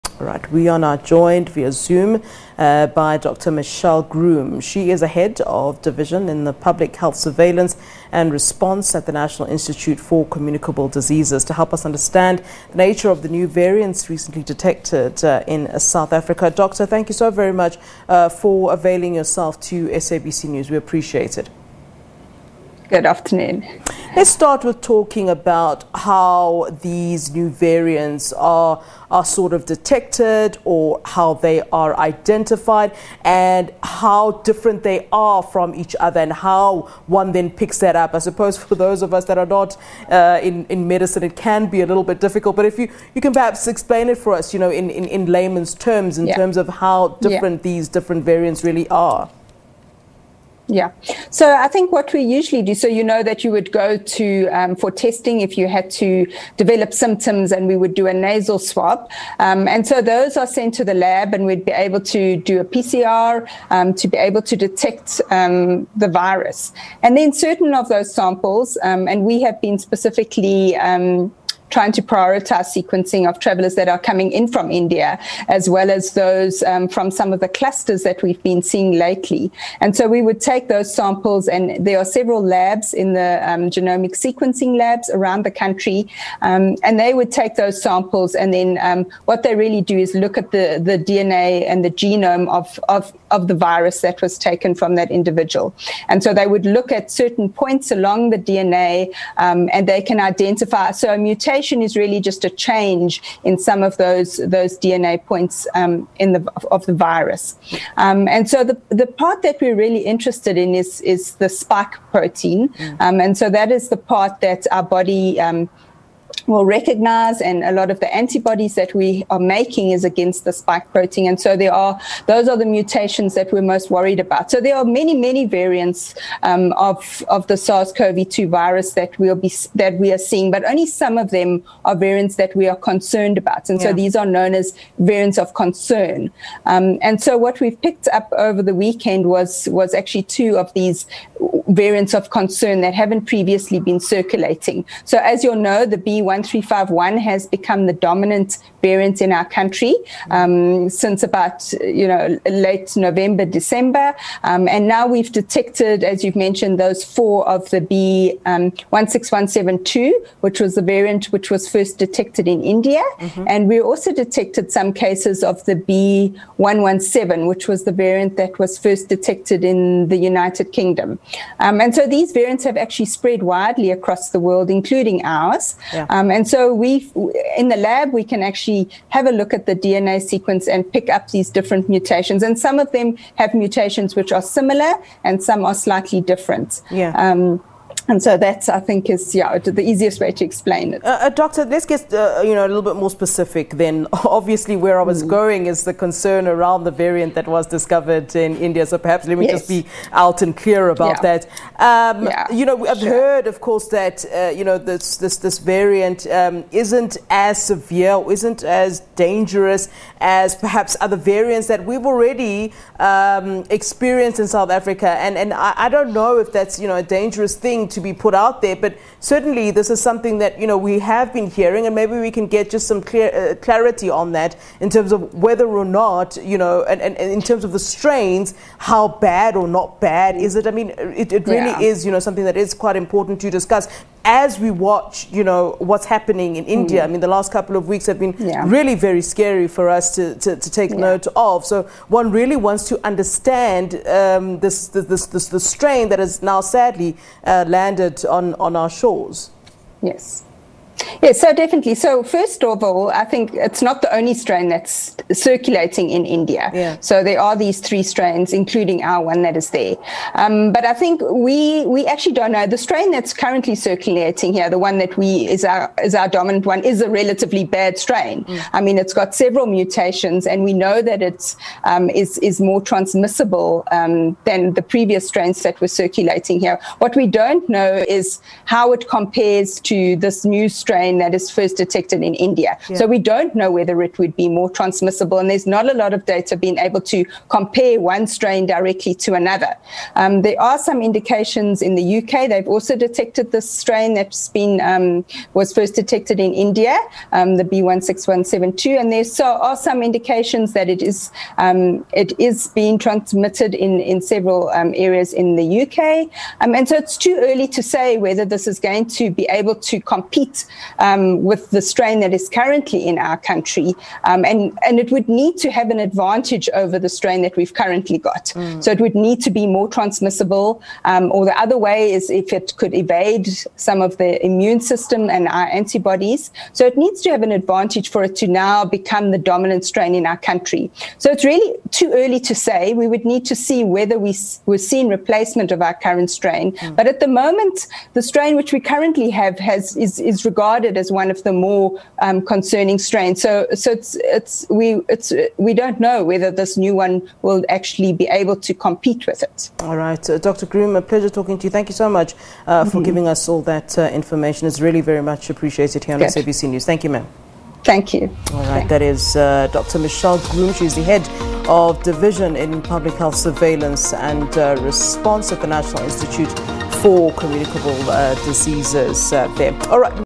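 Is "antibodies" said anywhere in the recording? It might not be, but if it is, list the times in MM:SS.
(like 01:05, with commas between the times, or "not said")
01:58, 05:25.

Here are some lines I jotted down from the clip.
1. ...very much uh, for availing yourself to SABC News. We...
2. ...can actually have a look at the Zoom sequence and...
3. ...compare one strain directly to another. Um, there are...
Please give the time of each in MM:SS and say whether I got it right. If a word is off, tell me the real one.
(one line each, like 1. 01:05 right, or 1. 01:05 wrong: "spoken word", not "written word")
1. 00:17 right
2. 02:58 wrong: "DNA", not "Zoom"
3. 04:47 right.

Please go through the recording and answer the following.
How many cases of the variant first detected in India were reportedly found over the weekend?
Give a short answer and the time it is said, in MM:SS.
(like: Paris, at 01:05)
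4, at 02:37.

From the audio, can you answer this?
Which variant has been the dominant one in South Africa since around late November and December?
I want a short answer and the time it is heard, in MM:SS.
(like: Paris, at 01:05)
B1 1351, at 02:25.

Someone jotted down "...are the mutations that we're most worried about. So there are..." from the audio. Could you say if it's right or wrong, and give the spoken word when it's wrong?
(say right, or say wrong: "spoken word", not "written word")
right.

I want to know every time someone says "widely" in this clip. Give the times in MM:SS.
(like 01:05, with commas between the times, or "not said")
02:53.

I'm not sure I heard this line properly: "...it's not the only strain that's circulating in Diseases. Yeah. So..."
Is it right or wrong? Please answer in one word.
wrong.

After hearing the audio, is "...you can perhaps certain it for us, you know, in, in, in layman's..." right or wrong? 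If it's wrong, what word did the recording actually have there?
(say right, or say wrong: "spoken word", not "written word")
wrong: "explain", not "certain".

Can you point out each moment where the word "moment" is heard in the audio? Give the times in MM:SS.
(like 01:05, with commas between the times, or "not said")
05:37.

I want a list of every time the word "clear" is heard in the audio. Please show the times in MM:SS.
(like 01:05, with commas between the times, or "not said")
03:20, 03:43.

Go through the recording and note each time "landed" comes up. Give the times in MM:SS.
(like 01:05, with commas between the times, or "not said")
04:07.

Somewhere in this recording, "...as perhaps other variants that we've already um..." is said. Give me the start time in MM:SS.
03:30.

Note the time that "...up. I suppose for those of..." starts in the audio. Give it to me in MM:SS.
00:37.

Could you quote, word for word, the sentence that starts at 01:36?
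And so they would look at certain points along the DNA, um, and they can identify.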